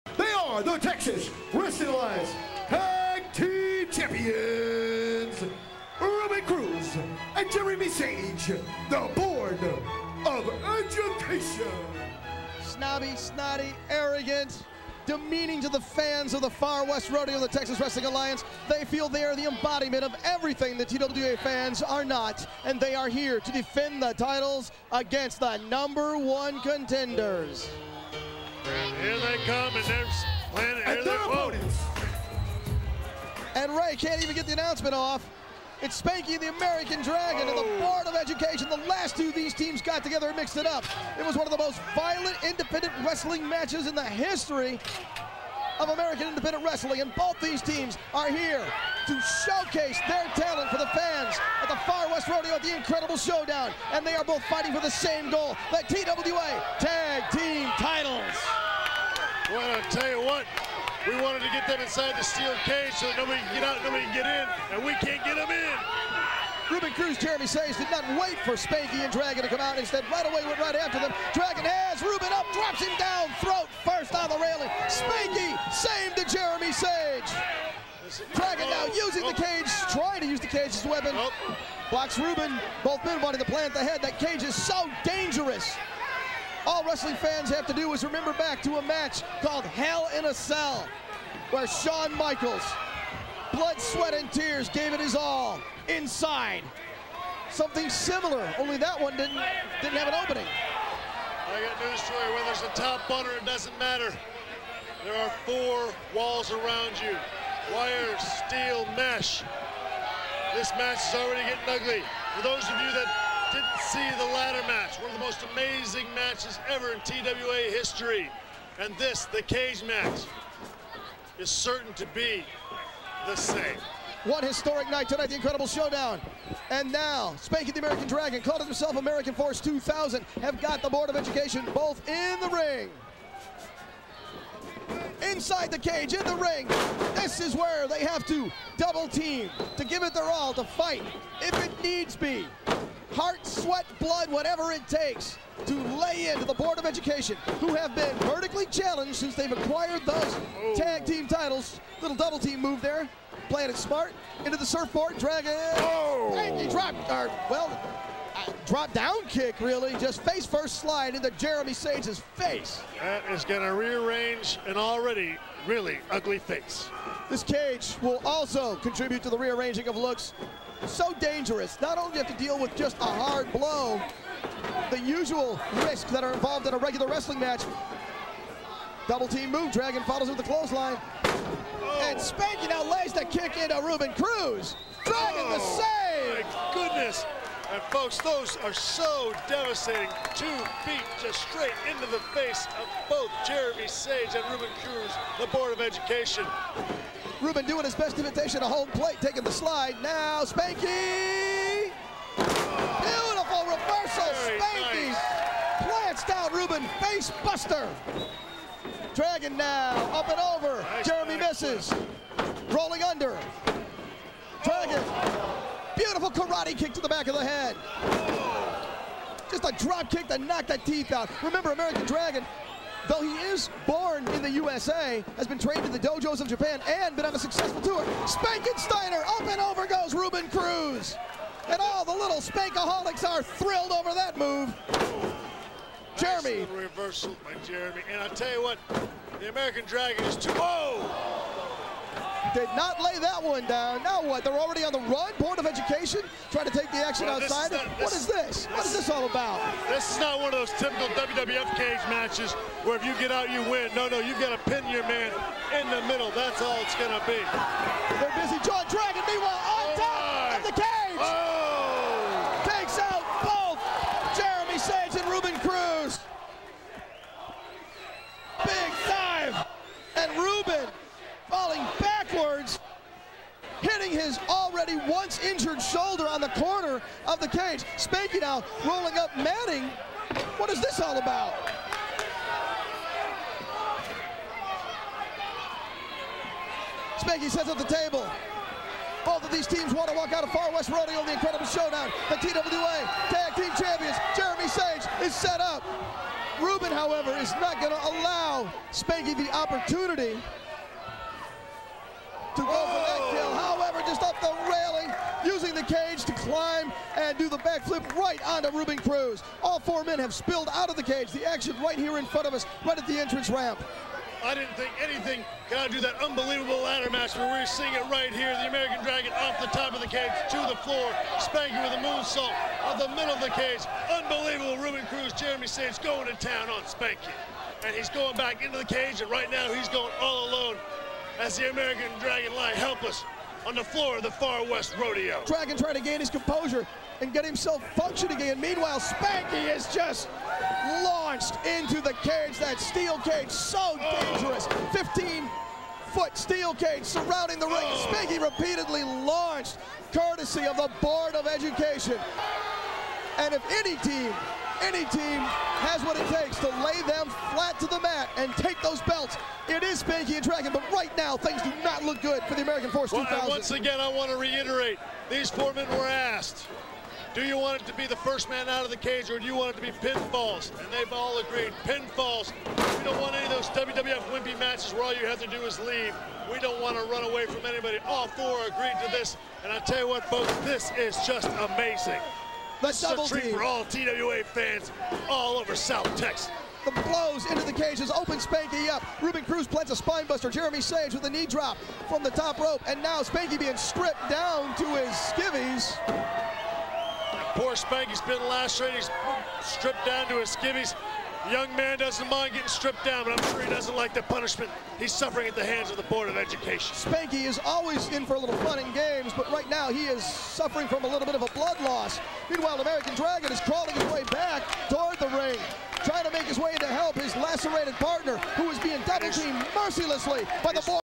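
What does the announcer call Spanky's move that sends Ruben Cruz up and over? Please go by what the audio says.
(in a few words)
Spankensteiner.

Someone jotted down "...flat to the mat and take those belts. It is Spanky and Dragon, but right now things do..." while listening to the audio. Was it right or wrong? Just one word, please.
right.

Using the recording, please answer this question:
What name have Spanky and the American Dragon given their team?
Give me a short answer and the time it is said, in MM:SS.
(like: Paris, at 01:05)
American Force 2000, at 02:08.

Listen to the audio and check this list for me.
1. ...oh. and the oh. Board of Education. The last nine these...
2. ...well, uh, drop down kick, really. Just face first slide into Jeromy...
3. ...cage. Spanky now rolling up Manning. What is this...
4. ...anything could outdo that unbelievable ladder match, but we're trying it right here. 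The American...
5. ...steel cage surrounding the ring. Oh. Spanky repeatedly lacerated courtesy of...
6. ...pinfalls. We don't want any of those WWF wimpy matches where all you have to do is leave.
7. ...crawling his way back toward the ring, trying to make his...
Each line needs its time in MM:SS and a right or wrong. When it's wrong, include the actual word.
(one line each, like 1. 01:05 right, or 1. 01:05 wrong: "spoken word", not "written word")
1. 00:37 wrong: "two", not "nine"
2. 02:37 right
3. 04:37 right
4. 05:15 wrong: "seeing", not "trying"
5. 05:46 wrong: "launched", not "lacerated"
6. 06:11 right
7. 06:53 right.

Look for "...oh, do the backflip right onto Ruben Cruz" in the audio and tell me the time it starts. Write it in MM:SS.
05:03.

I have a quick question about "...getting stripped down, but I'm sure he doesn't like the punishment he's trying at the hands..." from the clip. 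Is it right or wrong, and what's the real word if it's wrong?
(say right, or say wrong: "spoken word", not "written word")
wrong: "suffering", not "trying".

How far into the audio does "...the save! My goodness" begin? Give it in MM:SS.
03:05.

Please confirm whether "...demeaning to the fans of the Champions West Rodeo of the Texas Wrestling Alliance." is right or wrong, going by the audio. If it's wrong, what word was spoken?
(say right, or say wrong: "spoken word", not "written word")
wrong: "Far", not "Champions".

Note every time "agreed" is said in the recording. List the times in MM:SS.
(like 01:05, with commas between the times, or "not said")
06:11, 06:18.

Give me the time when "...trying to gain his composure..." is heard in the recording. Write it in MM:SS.
05:35.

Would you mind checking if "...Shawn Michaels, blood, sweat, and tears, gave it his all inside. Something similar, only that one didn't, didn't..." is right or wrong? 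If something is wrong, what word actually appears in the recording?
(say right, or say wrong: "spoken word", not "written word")
right.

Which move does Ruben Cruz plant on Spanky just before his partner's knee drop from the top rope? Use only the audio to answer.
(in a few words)
spinebuster.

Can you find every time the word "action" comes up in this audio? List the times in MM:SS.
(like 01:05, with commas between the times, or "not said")
04:06, 05:11.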